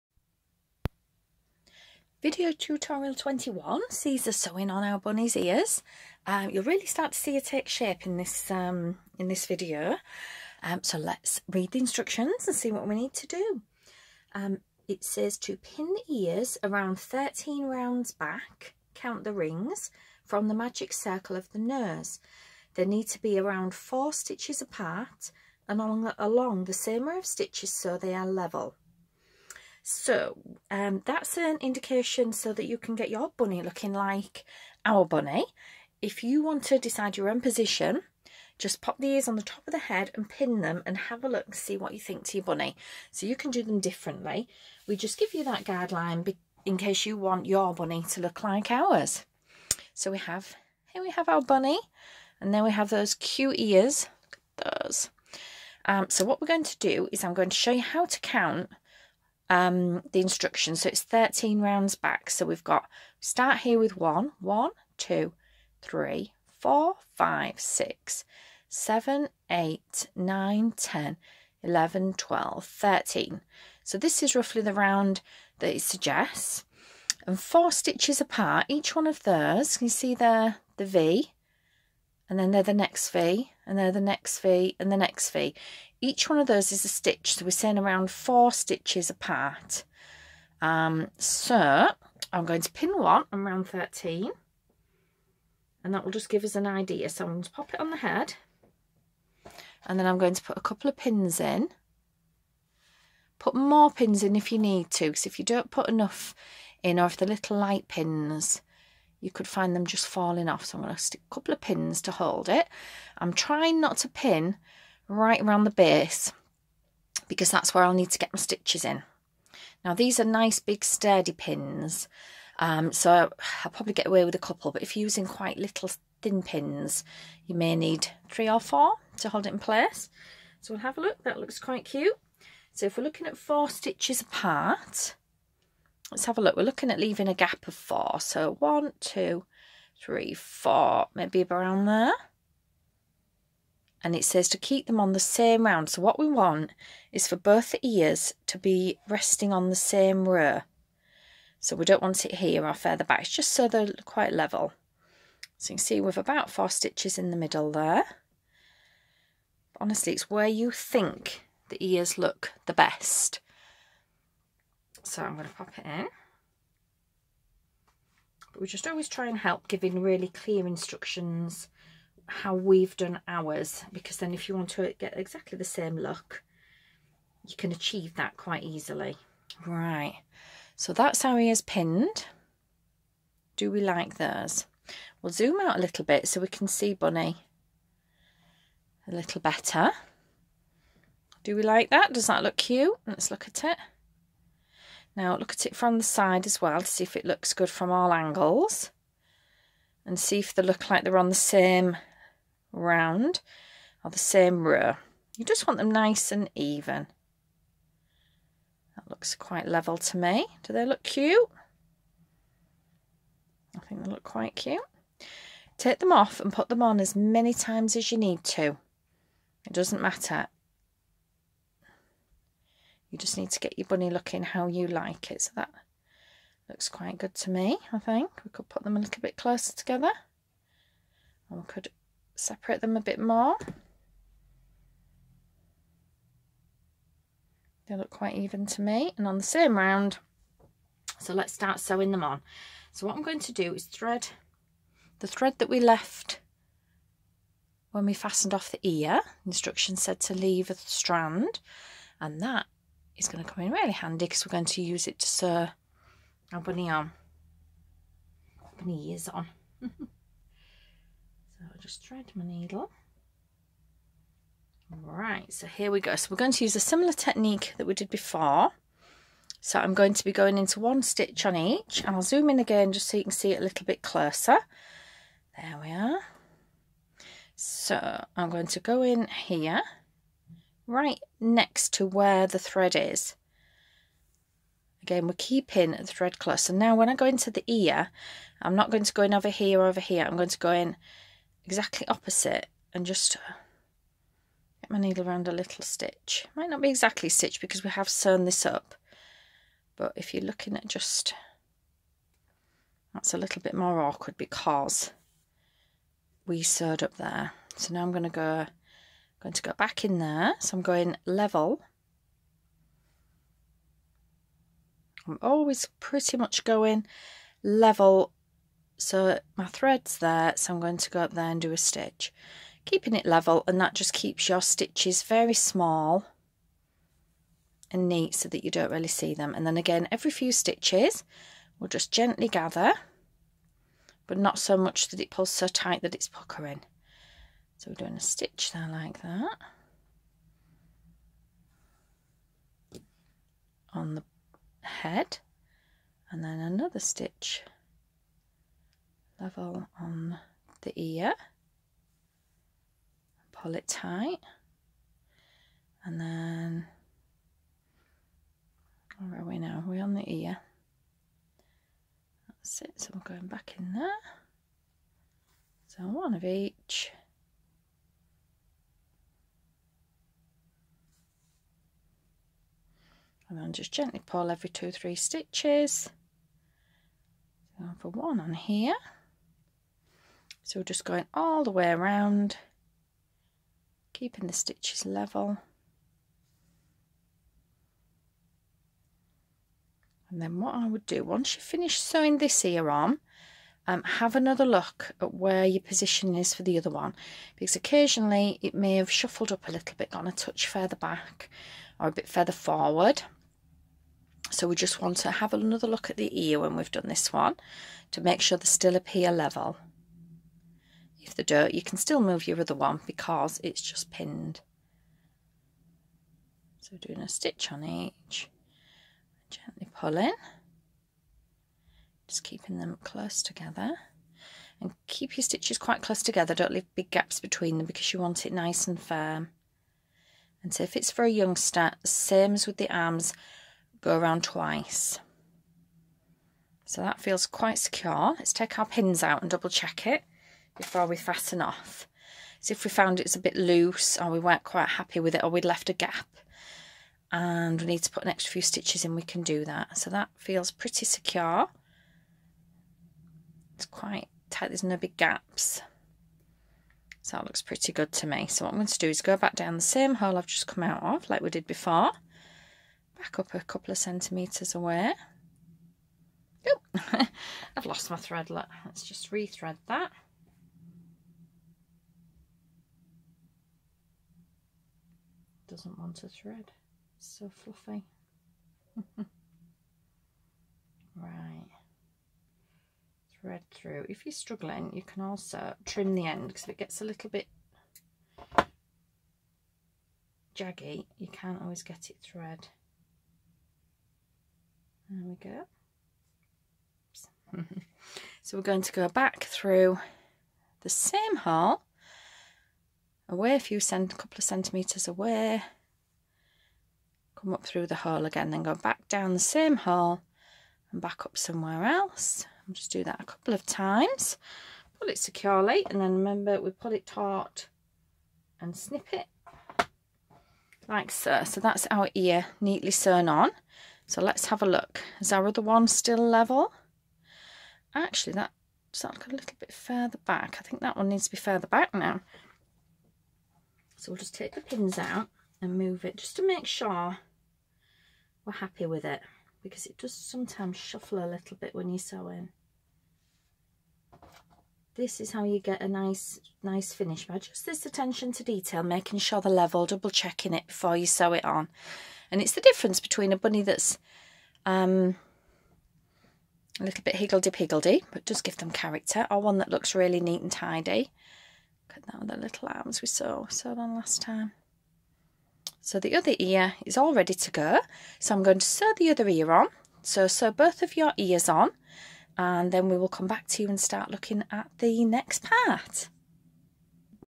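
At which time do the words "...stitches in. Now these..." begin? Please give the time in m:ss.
1:58.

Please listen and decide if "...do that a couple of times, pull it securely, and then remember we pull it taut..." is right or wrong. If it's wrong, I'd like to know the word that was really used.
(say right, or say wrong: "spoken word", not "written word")
right.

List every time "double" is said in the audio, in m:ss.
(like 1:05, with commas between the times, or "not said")
7:19, 9:09.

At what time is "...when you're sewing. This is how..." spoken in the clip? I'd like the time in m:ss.
9:01.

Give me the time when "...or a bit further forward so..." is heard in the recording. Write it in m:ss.
6:41.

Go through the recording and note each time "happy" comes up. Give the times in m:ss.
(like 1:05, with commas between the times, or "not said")
7:24, 8:58.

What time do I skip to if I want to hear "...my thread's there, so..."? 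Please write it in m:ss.
5:19.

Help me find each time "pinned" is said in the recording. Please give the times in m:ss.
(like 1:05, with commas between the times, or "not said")
3:01, 6:54.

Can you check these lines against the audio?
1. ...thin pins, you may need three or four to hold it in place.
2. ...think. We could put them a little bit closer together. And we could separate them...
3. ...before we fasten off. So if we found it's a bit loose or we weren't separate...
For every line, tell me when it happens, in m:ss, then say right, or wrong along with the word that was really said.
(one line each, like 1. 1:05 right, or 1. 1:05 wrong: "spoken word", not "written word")
1. 2:06 right
2. 3:47 right
3. 7:20 wrong: "quite", not "separate".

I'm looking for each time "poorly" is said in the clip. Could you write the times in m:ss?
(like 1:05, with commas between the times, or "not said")
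not said.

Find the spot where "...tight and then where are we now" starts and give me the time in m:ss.
5:53.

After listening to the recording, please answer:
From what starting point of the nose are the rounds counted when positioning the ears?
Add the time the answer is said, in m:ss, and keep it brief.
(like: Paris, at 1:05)
magic circle, at 0:20.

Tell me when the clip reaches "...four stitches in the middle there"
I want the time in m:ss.
2:36.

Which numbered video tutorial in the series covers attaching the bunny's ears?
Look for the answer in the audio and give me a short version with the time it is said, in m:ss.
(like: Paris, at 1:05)
21, at 0:03.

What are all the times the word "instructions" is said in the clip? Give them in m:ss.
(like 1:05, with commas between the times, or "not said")
0:11, 1:00, 2:50, 4:09.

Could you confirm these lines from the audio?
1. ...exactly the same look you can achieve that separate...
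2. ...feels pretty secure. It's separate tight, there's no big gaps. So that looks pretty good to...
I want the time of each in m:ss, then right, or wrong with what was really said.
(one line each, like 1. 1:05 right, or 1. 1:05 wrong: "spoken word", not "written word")
1. 2:55 wrong: "quite", not "separate"
2. 7:30 wrong: "quite", not "separate".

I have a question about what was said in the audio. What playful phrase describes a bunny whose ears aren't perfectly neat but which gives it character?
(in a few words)
higgledy-piggledy.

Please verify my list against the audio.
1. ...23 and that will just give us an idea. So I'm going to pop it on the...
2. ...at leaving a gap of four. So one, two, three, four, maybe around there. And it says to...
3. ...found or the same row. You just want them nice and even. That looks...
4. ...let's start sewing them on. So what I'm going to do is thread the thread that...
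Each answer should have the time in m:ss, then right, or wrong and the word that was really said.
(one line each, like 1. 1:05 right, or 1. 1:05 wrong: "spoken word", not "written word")
1. 1:33 wrong: "13", not "23"
2. 2:16 right
3. 3:22 wrong: "round", not "found"
4. 4:01 right.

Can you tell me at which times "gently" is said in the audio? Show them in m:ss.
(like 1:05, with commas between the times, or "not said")
5:32, 6:13, 6:59.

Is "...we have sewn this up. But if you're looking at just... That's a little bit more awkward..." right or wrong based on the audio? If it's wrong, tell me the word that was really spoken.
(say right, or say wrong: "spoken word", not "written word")
right.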